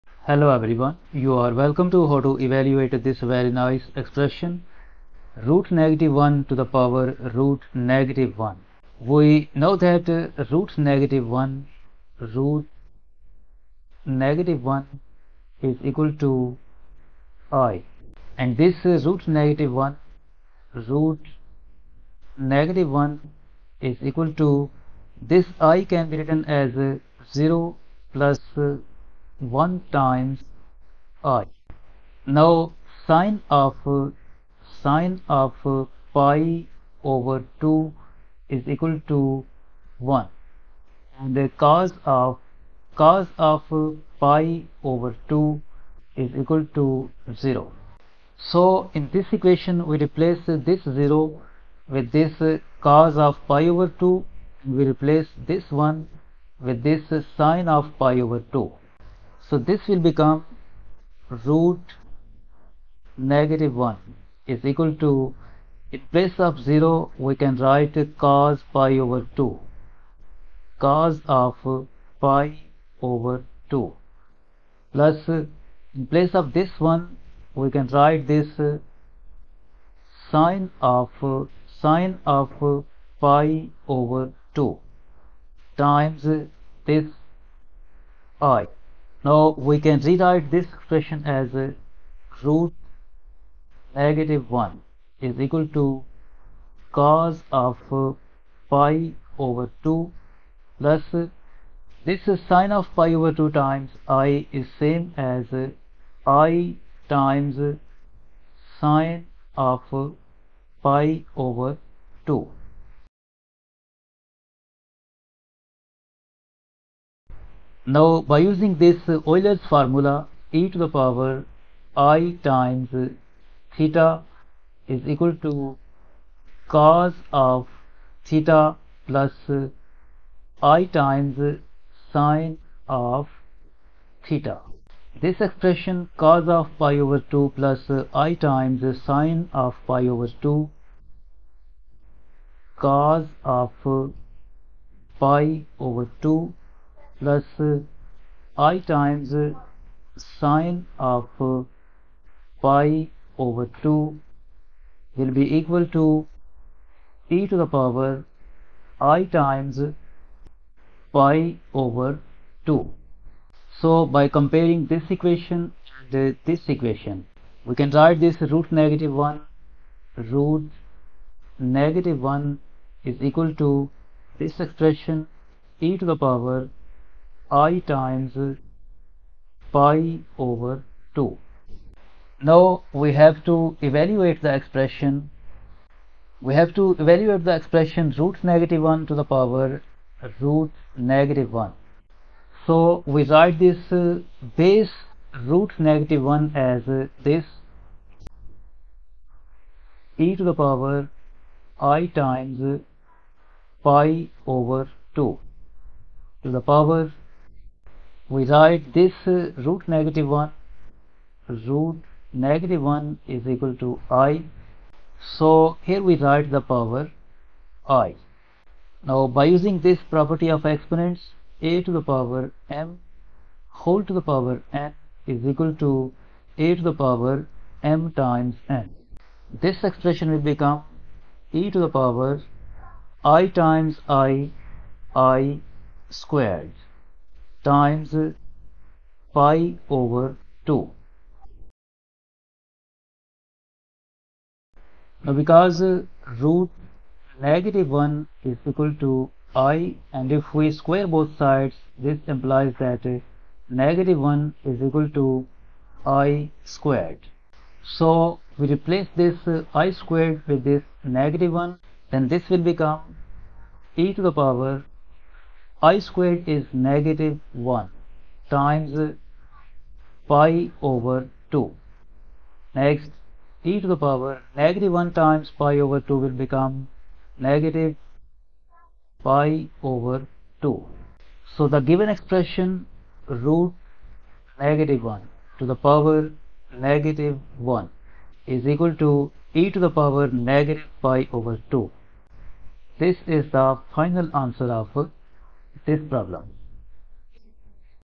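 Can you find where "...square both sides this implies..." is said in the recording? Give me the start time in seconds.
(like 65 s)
250 s.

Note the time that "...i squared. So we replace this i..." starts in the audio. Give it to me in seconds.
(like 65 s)
256 s.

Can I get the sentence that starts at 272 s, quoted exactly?
Next, e to the power negative 1 times pi over 2 will become negative pi over 2.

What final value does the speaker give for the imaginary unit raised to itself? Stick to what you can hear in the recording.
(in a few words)
e^(-pi/2).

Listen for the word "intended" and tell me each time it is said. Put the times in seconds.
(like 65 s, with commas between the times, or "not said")
not said.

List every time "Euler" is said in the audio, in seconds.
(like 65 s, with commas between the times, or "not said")
119 s.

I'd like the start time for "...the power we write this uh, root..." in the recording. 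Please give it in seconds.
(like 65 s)
206 s.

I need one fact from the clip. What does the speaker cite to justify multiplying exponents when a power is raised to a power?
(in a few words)
property of exponents.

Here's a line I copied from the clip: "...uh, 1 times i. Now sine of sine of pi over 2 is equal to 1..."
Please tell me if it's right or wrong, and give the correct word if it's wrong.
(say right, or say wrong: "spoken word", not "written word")
right.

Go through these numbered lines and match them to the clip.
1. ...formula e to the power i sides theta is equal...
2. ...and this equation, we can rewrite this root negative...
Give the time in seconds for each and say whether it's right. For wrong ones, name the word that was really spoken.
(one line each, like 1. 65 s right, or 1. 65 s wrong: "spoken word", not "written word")
1. 119 s wrong: "times", not "sides"
2. 166 s wrong: "write", not "rewrite".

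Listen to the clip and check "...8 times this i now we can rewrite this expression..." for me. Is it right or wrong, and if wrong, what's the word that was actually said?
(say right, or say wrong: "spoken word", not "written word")
wrong: "2", not "8".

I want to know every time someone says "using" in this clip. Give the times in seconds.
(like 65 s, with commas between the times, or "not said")
118 s, 219 s.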